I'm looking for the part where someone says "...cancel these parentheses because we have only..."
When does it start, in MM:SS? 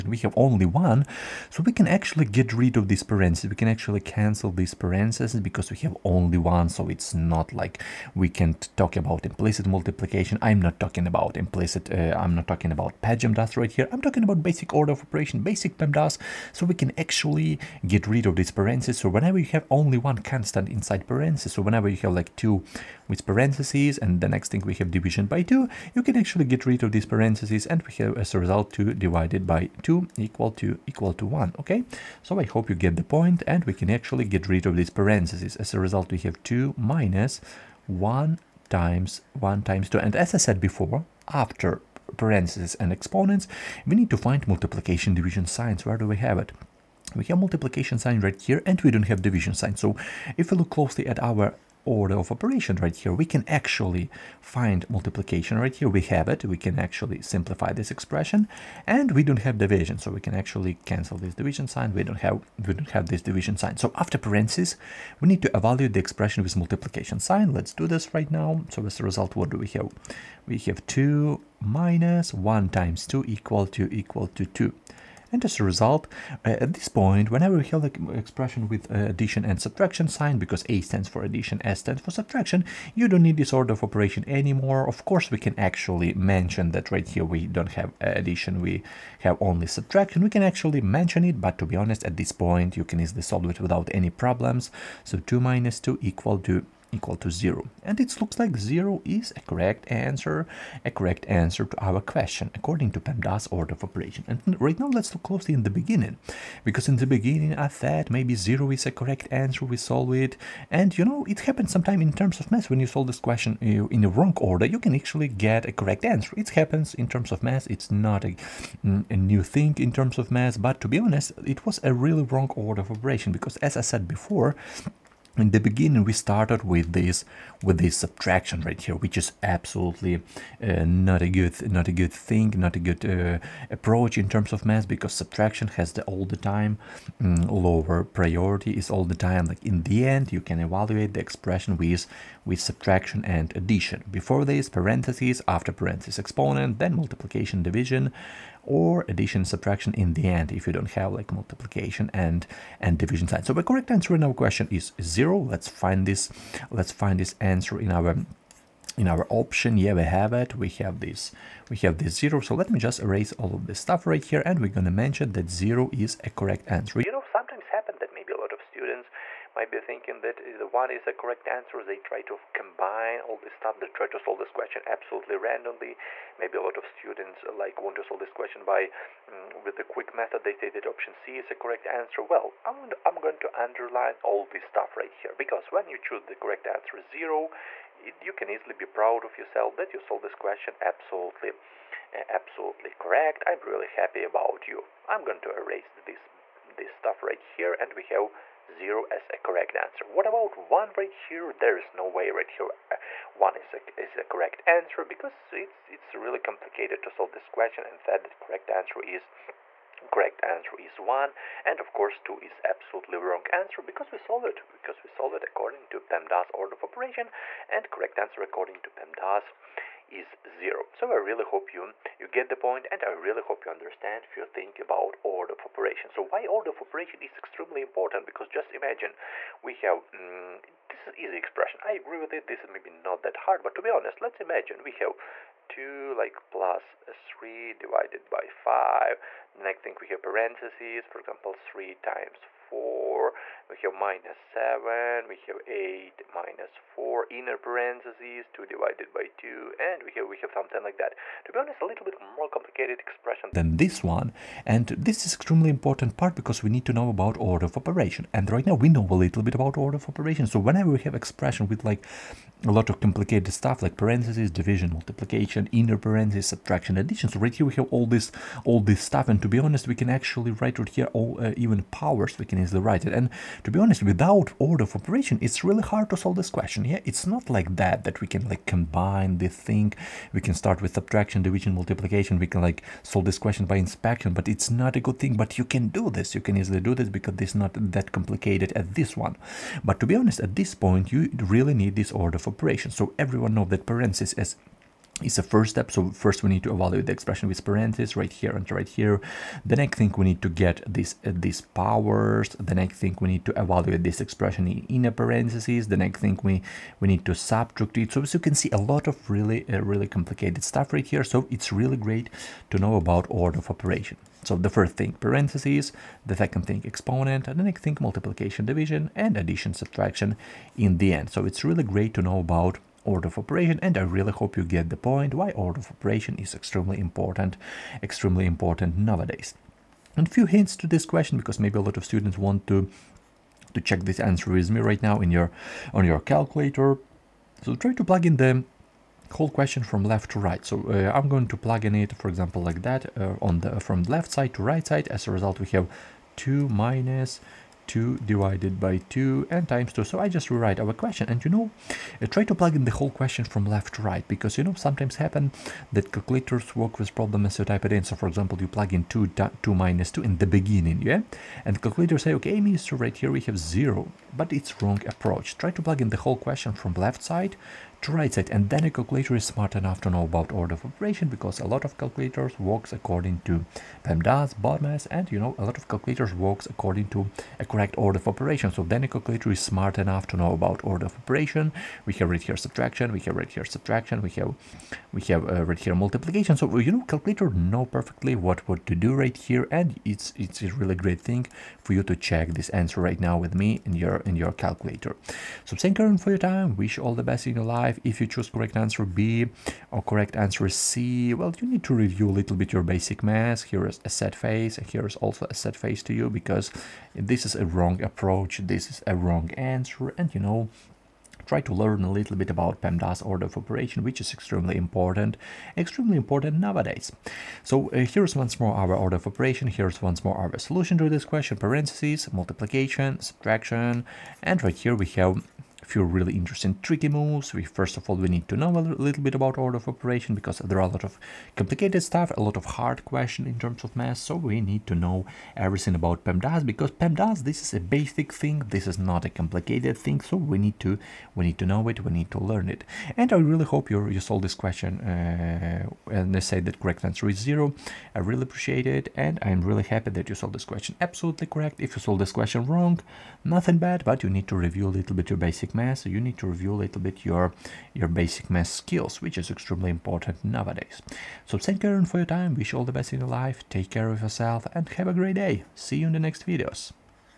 00:03.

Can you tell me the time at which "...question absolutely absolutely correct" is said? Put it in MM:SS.
03:10.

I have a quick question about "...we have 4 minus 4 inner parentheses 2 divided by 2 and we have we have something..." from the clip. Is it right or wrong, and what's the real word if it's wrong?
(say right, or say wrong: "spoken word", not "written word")
wrong: "8", not "4".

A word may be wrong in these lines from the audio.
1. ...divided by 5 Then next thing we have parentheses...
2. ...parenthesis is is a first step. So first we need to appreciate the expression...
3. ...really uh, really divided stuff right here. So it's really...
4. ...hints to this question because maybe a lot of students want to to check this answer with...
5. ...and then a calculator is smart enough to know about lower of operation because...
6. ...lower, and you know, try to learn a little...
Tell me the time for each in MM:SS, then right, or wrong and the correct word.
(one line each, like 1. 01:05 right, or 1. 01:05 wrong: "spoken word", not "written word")
1. 03:57 right
2. 04:53 wrong: "evaluate", not "appreciate"
3. 05:09 wrong: "complicated", not "divided"
4. 05:30 right
5. 06:08 wrong: "order", not "lower"
6. 06:49 wrong: "answer", not "lower".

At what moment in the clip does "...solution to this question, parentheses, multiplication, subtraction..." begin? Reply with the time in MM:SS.
07:00.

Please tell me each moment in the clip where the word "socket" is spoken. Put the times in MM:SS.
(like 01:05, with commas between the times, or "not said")
not said.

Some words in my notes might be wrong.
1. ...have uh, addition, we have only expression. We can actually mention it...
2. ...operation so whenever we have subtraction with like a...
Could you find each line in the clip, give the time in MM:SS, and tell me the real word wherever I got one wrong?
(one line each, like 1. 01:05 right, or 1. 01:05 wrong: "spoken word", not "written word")
1. 01:27 wrong: "subtraction", not "expression"
2. 04:20 wrong: "expression", not "subtraction".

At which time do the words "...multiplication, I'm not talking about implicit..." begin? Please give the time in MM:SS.
00:09.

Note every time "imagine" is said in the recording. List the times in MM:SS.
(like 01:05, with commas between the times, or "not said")
03:48, 03:54.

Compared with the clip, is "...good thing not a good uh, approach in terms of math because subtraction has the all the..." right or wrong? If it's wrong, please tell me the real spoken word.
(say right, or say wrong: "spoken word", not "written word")
right.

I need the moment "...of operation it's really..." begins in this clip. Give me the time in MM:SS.
04:34.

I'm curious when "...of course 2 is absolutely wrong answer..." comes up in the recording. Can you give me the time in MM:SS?
03:31.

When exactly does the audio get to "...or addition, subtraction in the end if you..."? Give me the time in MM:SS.
02:28.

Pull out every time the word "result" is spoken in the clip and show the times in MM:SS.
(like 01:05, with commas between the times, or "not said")
00:28, 00:35, 01:09, 01:15, 05:45.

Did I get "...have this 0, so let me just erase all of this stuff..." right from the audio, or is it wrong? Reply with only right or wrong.
right.